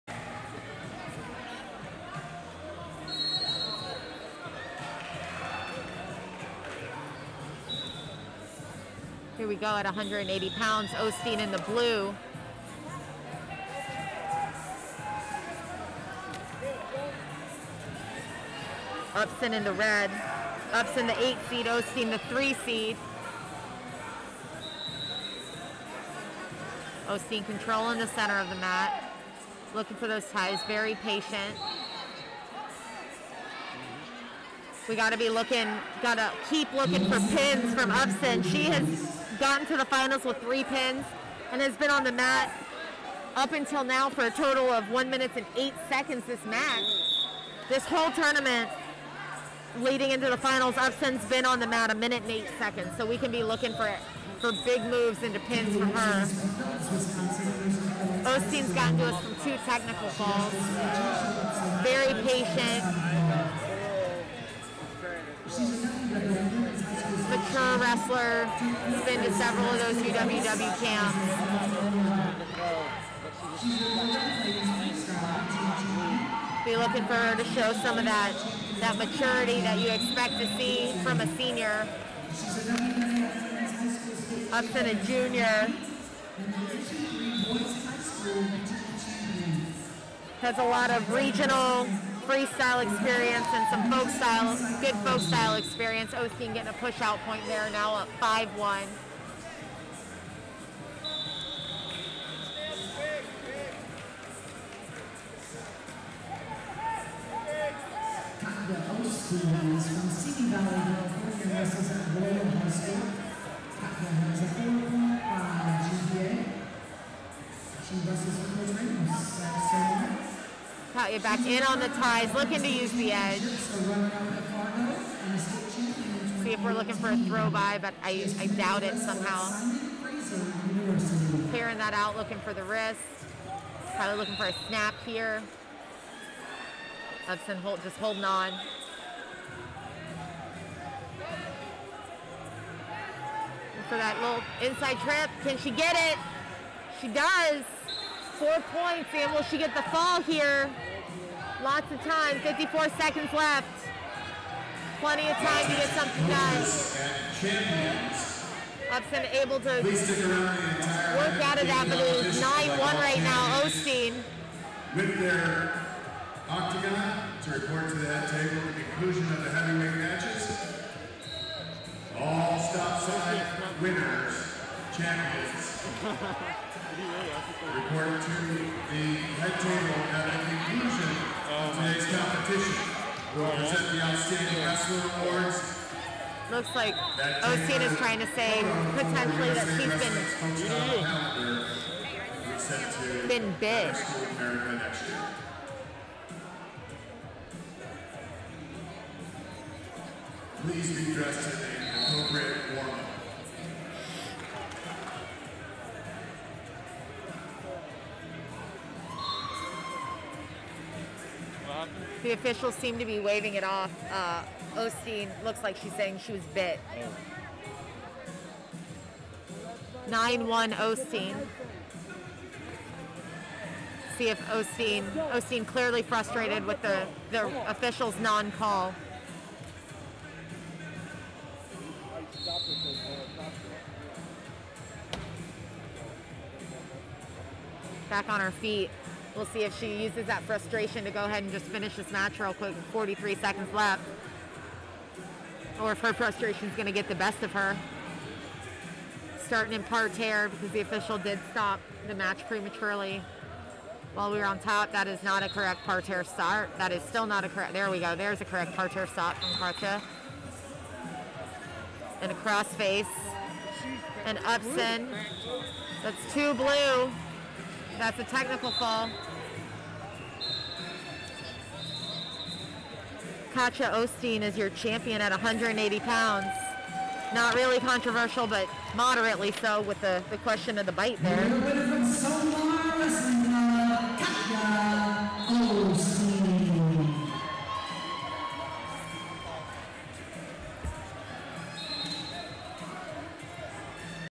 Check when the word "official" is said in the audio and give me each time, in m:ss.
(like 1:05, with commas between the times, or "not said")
3:32, 3:47, 4:10.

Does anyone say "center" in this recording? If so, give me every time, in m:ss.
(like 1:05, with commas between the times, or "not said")
0:28.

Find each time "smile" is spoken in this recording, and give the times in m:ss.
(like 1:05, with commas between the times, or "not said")
not said.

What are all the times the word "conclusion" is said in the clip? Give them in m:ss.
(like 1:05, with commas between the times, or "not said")
2:48, 3:00.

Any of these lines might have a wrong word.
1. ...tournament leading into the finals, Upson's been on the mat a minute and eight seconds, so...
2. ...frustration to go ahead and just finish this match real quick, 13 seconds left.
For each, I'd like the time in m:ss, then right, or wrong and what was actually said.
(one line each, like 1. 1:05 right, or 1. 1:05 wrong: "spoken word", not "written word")
1. 0:48 right
2. 4:00 wrong: "43", not "13".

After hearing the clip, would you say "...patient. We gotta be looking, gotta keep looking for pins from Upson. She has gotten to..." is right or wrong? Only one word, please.
right.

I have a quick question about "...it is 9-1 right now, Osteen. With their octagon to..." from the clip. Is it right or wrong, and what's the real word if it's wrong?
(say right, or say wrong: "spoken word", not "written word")
right.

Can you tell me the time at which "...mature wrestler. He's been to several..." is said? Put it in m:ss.
1:07.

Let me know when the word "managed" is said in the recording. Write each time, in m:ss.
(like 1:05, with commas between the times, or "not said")
not said.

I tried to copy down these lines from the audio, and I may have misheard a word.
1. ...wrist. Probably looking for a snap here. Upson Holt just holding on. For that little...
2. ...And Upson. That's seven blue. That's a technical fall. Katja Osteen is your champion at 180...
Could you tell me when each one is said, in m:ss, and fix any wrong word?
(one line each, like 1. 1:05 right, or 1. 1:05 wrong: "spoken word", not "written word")
1. 2:12 right
2. 4:24 wrong: "two", not "seven".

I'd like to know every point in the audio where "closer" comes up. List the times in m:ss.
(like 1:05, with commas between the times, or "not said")
not said.